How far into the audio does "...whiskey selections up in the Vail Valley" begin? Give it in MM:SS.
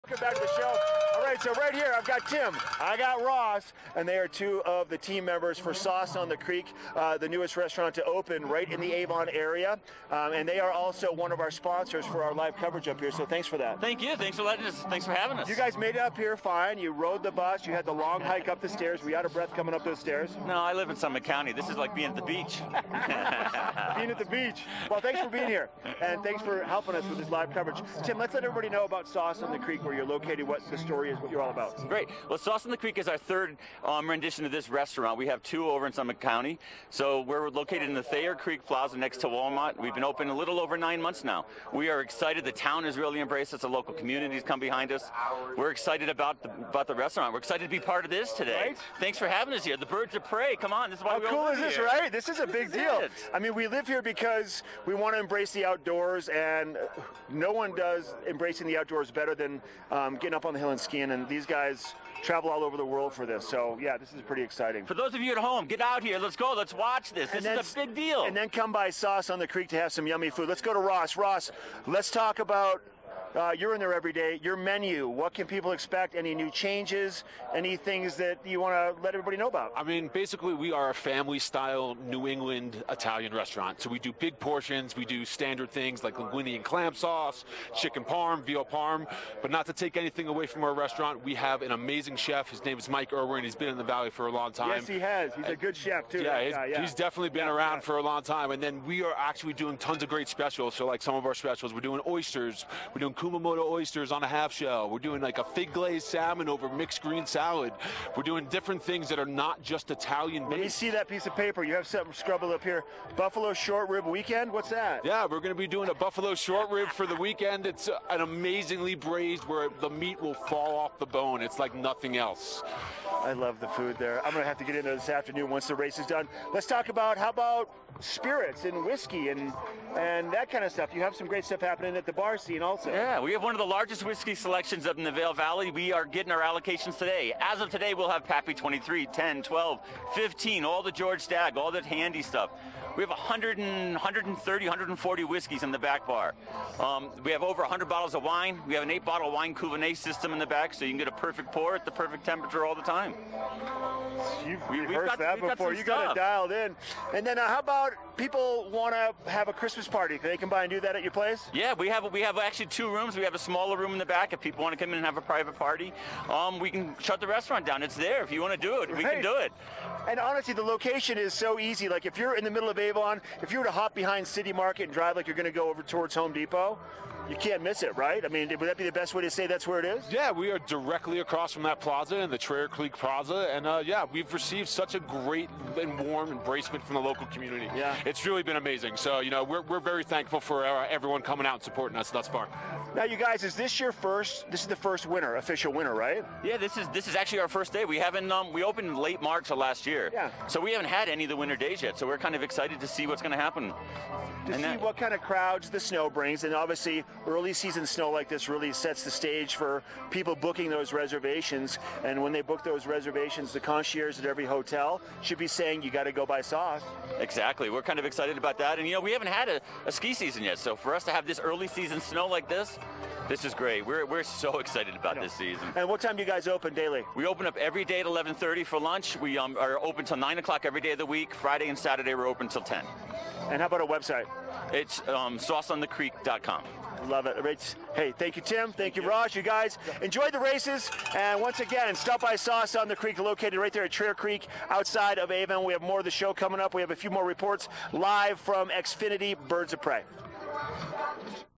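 02:14.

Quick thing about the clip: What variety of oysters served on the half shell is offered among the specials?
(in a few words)
Kumamoto.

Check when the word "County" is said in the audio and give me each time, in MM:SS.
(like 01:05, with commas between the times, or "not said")
00:21, 00:36.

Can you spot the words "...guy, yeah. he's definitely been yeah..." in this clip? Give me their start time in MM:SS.
01:36.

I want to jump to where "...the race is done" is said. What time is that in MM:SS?
02:05.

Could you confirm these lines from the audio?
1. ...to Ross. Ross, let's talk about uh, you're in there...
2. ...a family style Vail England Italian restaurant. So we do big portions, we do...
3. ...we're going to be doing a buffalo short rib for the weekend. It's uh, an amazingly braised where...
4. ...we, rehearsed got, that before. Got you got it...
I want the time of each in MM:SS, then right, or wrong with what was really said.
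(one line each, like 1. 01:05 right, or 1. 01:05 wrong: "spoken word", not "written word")
1. 01:10 right
2. 01:20 wrong: "New", not "Vail"
3. 01:55 right
4. 02:34 right.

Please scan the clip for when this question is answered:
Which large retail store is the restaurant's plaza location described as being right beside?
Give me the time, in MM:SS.
00:39.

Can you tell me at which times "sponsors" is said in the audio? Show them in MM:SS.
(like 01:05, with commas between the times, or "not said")
00:11.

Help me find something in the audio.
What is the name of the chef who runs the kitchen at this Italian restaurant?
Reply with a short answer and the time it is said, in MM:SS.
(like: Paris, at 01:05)
Mike Irwin, at 01:32.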